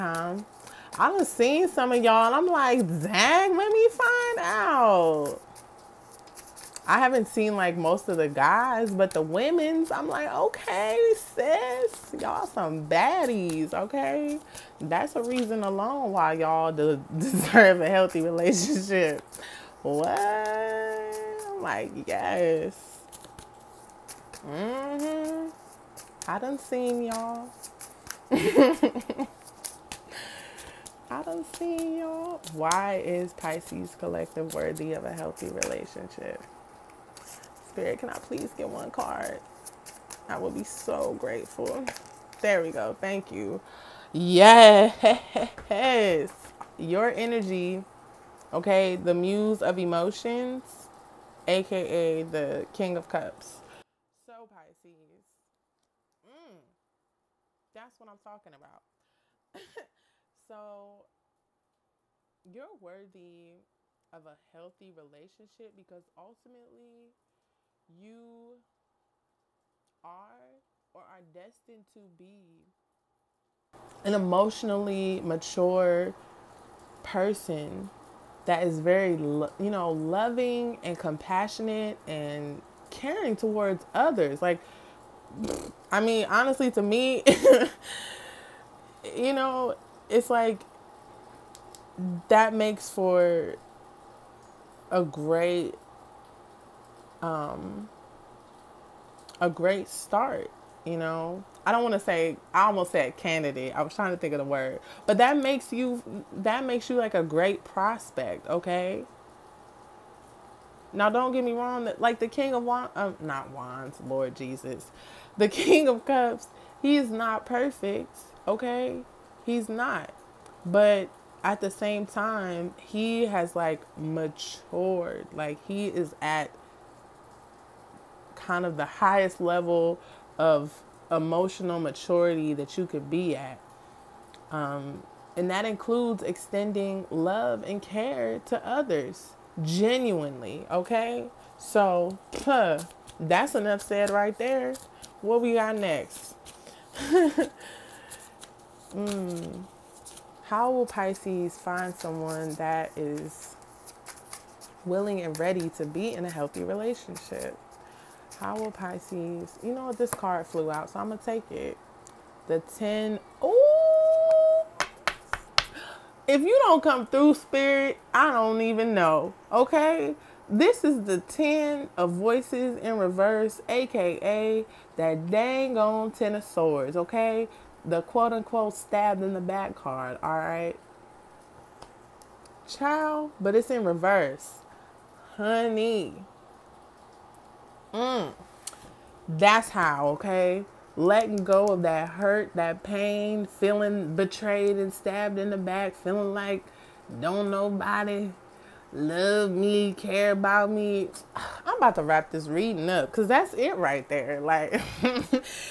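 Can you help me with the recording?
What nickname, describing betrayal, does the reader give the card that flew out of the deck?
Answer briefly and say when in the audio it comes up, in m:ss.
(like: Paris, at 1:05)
stabbed in the back card, at 2:58.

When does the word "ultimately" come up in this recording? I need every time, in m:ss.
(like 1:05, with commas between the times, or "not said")
1:06.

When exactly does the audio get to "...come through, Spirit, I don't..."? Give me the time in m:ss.
2:46.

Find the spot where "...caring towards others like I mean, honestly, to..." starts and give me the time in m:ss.
1:22.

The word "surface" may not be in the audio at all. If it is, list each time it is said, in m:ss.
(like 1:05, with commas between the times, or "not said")
not said.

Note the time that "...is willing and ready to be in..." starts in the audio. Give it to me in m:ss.
2:32.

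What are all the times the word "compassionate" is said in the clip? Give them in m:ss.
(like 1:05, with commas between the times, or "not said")
1:20.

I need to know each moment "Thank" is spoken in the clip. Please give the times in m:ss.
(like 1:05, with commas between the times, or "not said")
0:42.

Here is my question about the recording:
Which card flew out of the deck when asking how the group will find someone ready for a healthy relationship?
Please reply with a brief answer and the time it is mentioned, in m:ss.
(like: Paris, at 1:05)
10 of Swords, at 2:56.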